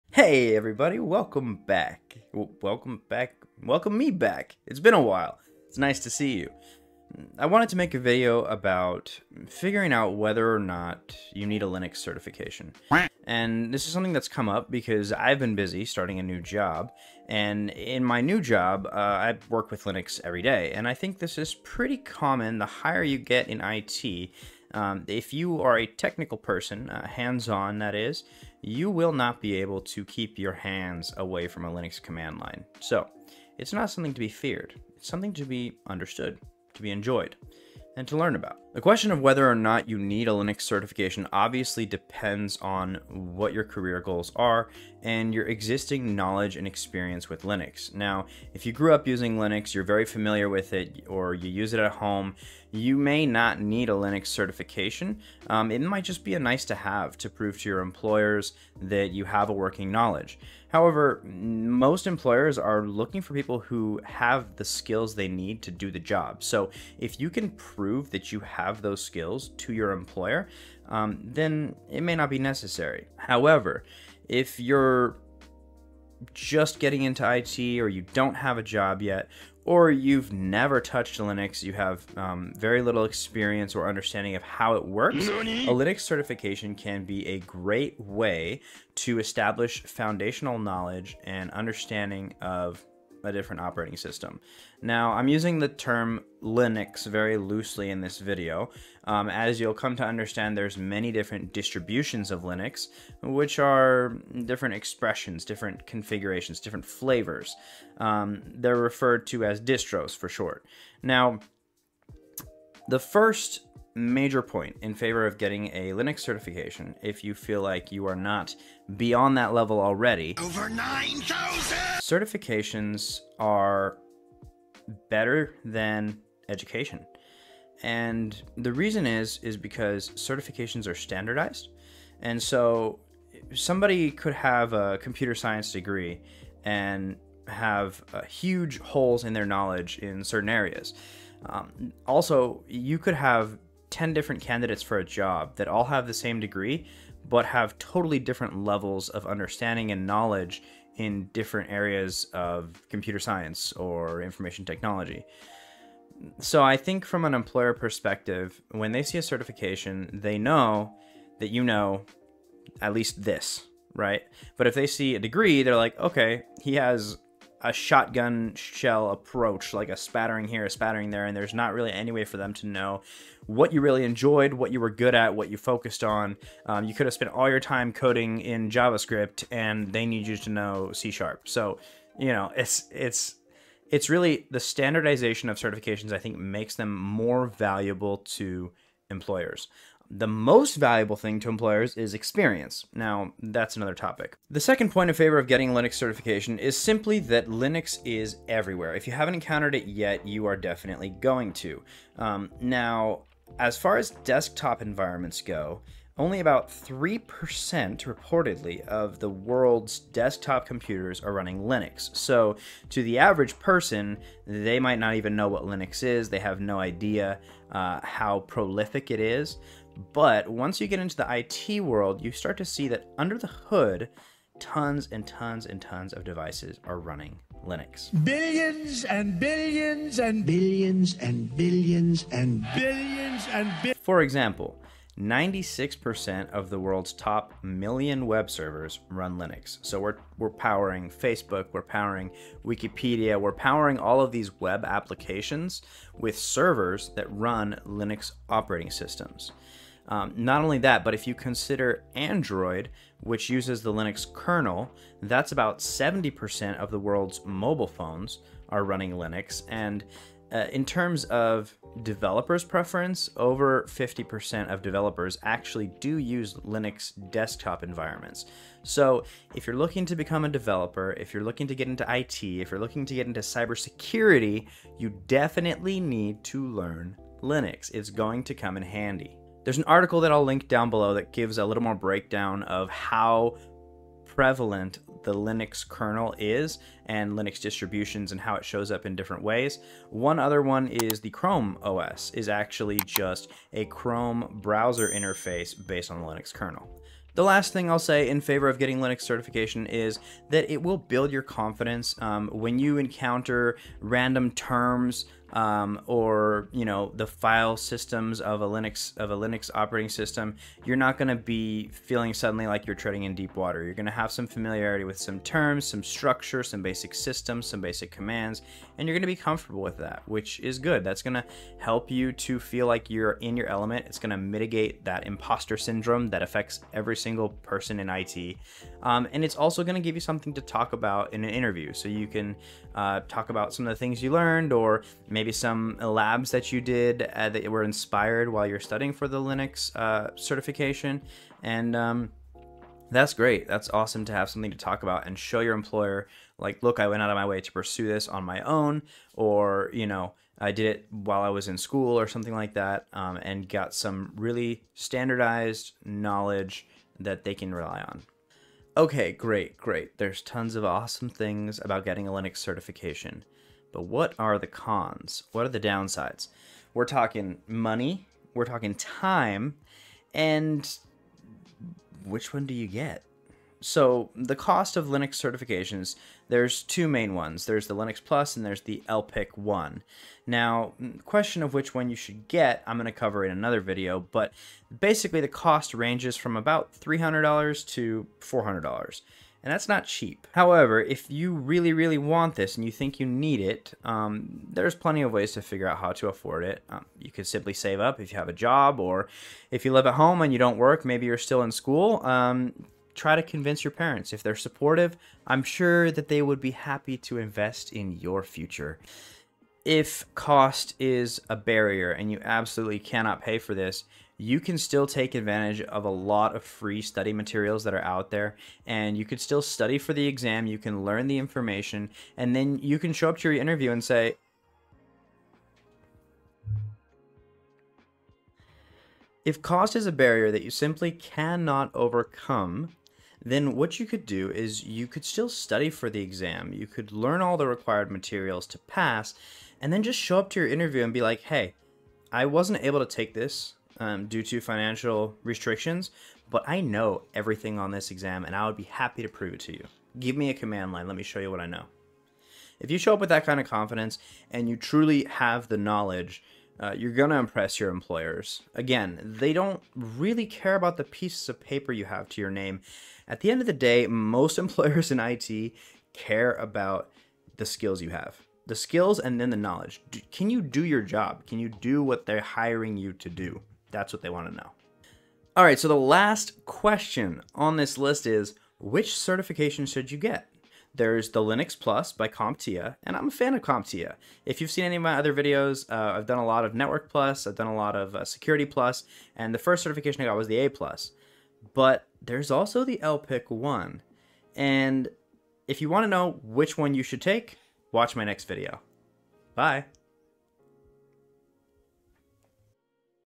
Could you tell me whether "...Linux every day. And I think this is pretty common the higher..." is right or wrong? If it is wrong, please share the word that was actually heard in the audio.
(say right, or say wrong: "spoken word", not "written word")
right.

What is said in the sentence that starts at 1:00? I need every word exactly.
However, most employers are looking for people who have the skills they need to do the job.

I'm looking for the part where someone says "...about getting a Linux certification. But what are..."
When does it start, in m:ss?
6:01.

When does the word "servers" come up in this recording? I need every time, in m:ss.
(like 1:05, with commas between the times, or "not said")
3:58, 4:06.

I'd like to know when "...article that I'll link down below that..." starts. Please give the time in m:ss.
4:39.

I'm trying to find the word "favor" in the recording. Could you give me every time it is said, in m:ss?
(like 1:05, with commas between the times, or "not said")
1:54, 3:15, 4:58.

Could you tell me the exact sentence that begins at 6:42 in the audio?
Um, try to convince your parents.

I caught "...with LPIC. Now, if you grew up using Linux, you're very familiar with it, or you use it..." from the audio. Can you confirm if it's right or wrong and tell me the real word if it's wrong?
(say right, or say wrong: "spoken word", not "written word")
wrong: "Linux", not "LPIC".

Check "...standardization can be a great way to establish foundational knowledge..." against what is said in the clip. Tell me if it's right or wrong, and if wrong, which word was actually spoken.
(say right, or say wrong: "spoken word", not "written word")
wrong: "certification", not "standardization".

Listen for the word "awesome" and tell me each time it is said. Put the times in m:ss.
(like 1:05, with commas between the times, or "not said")
5:43, 6:00.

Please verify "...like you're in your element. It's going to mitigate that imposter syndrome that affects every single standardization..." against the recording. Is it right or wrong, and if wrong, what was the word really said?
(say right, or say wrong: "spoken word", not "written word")
wrong: "person", not "standardization".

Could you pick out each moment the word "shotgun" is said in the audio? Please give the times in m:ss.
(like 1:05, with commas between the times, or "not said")
2:47.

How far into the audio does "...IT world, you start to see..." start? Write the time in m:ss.
3:41.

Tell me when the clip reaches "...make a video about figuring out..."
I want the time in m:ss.
0:07.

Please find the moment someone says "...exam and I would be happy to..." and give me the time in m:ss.
7:28.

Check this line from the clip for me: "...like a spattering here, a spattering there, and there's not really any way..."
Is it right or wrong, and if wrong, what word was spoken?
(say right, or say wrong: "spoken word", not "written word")
right.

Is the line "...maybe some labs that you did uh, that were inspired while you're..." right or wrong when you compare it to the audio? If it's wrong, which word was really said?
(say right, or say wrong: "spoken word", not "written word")
right.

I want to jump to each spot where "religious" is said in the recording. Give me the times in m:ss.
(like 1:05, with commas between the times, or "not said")
not said.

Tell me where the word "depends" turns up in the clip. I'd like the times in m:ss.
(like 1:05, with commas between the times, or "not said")
0:41.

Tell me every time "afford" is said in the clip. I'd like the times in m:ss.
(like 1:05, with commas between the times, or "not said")
6:36.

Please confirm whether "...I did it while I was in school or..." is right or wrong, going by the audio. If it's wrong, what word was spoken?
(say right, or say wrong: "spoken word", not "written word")
right.